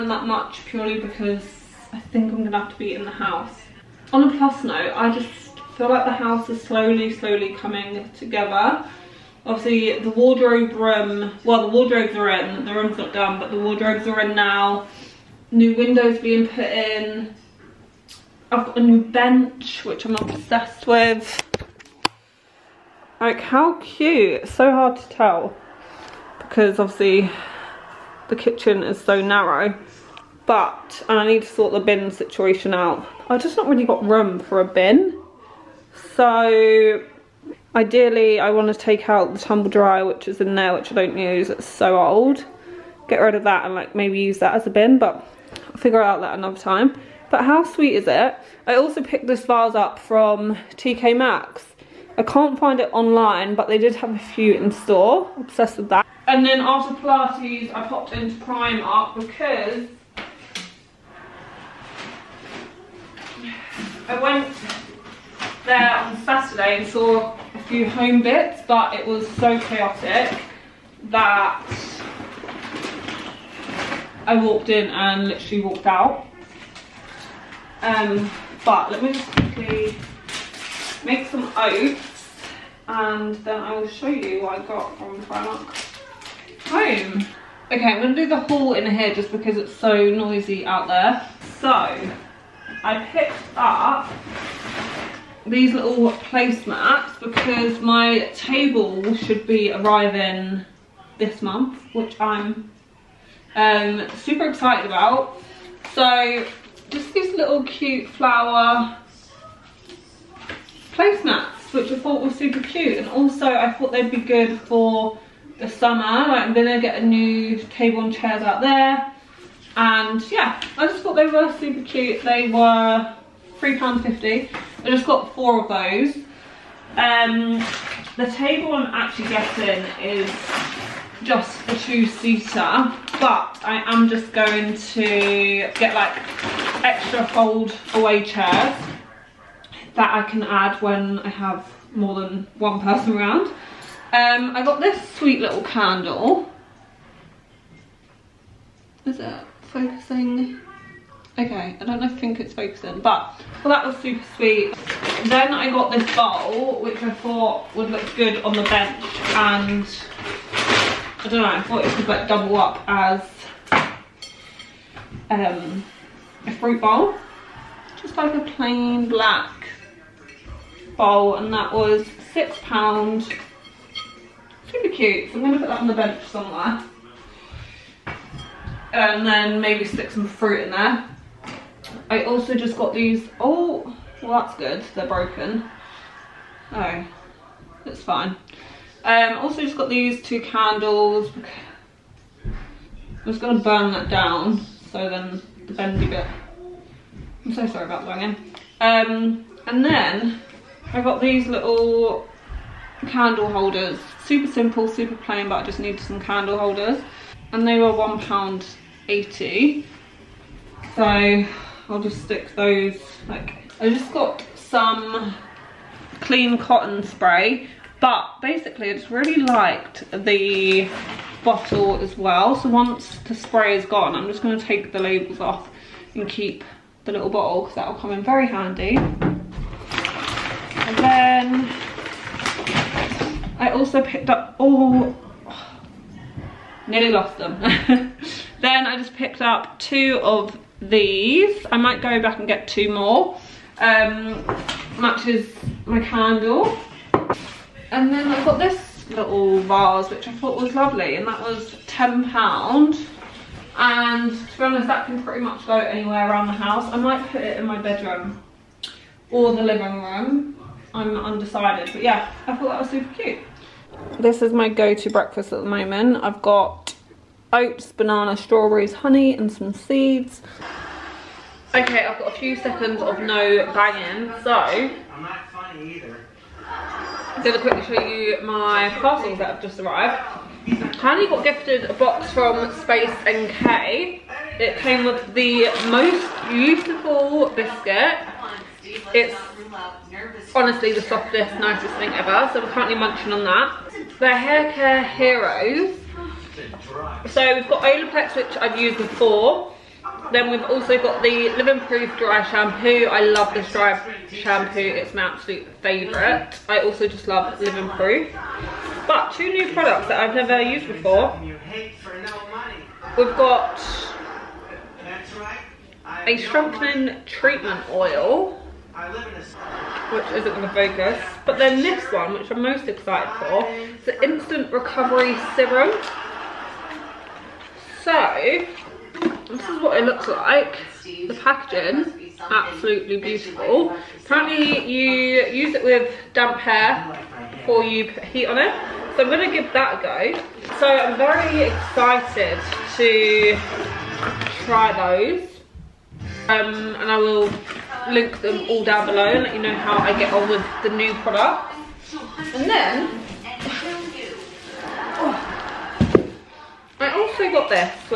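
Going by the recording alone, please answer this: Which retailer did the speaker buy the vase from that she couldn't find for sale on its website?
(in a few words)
TK Maxx.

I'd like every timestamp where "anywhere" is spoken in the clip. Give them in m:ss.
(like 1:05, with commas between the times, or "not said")
4:15.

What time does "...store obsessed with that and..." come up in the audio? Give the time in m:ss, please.
0:54.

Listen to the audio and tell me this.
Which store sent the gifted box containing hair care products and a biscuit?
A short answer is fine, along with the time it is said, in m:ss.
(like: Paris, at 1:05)
Space NK, at 4:42.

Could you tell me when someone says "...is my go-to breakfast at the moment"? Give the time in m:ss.
4:24.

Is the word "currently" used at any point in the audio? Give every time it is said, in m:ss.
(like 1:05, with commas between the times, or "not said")
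4:52.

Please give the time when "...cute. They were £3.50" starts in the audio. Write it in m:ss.
2:01.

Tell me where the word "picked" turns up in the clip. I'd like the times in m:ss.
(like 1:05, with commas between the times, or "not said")
0:49, 1:33, 3:54, 3:59.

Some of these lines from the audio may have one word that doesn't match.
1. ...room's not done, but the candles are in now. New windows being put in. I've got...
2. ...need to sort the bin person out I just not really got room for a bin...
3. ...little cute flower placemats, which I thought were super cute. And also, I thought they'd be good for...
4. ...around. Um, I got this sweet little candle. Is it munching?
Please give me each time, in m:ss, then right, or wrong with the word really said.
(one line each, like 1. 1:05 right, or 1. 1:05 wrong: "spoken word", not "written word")
1. 0:12 wrong: "wardrobes", not "candles"
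2. 0:31 wrong: "situation", not "person"
3. 1:47 right
4. 2:23 wrong: "focusing", not "munching".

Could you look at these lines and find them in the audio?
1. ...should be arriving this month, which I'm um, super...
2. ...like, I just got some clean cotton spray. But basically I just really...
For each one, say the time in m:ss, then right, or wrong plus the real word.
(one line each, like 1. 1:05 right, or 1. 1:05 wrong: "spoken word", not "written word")
1. 1:39 right
2. 3:33 right.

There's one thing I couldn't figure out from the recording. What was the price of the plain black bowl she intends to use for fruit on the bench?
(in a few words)
£6.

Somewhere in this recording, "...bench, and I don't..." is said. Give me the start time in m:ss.
2:38.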